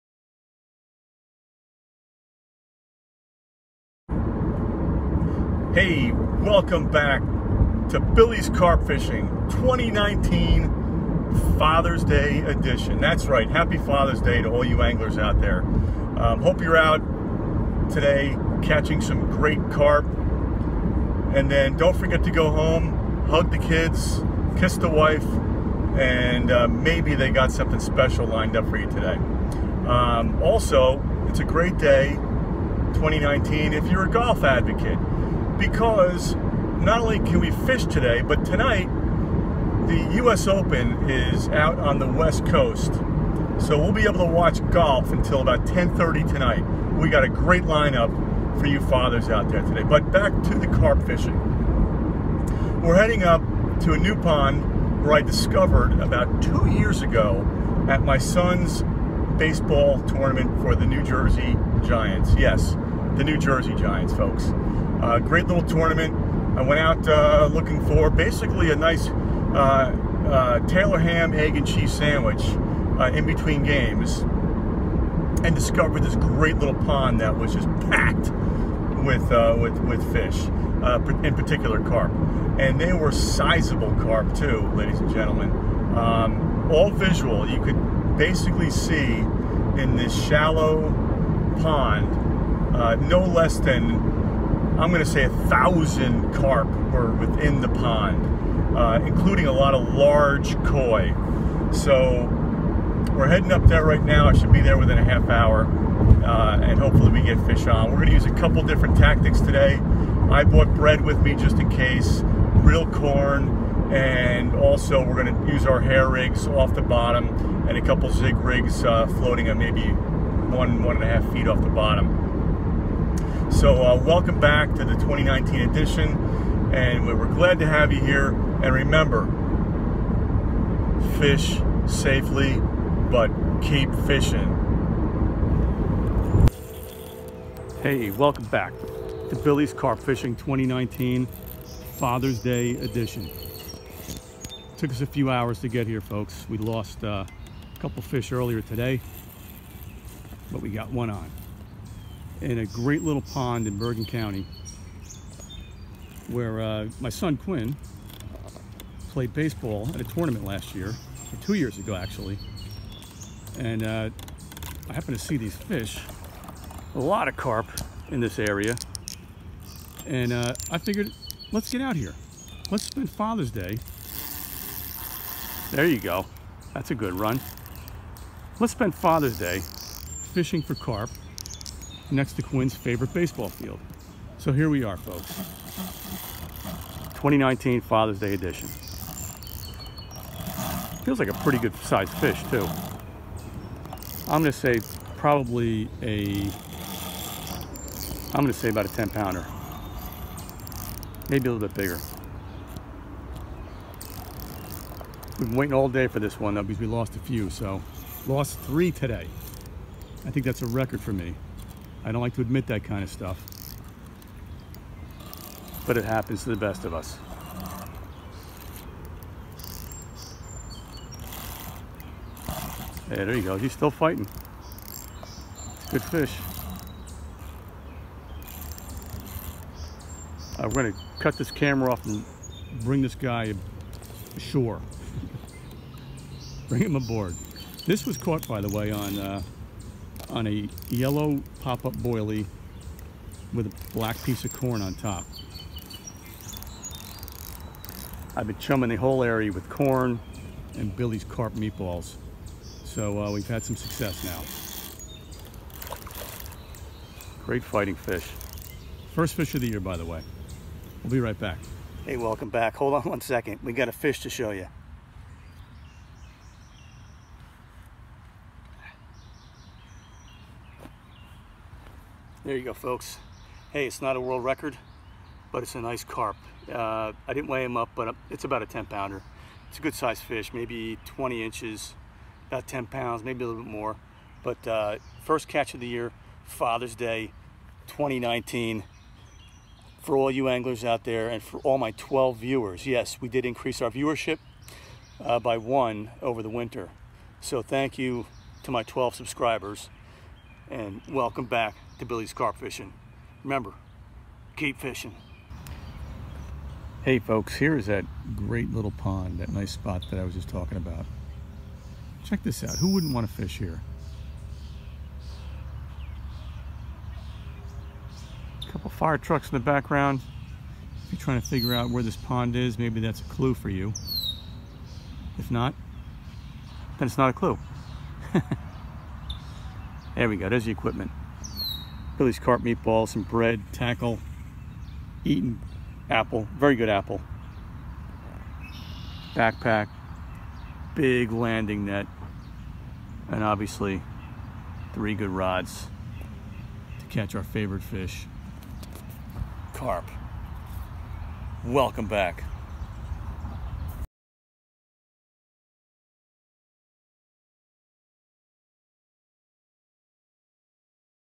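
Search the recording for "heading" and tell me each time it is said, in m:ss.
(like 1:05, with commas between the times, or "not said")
0:52, 1:43.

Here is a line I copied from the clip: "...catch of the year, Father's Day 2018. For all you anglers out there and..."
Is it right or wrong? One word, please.
wrong.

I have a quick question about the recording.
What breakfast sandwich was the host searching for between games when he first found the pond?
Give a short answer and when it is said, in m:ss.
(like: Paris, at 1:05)
Taylor ham, egg, and cheese, at 1:10.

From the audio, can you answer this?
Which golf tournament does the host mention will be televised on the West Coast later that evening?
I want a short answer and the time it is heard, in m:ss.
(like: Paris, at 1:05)
U.S. Open, at 0:40.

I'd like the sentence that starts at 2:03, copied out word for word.
So uh, welcome back to the 2019 edition, and we're glad to have you here.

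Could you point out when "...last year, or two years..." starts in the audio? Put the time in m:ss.
2:40.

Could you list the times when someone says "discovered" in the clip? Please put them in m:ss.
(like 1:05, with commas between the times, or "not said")
0:55, 1:15.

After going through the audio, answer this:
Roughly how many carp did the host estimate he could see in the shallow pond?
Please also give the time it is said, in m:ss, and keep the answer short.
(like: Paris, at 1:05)
1,000, at 1:35.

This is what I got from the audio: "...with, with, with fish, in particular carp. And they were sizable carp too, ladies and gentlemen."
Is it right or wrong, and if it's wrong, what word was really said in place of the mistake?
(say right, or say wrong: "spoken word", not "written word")
right.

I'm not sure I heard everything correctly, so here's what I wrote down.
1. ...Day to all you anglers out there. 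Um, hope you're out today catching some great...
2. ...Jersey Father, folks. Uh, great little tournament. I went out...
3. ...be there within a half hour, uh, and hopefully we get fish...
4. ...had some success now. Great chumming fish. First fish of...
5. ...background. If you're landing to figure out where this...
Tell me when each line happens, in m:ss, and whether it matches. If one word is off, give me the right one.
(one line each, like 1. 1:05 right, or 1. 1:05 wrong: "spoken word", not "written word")
1. 0:14 right
2. 1:03 wrong: "Giants", not "Father"
3. 1:44 right
4. 4:13 wrong: "fighting", not "chumming"
5. 5:19 wrong: "trying", not "landing".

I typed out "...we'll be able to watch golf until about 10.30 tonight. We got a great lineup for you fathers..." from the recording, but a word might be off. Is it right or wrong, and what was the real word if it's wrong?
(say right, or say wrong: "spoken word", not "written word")
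right.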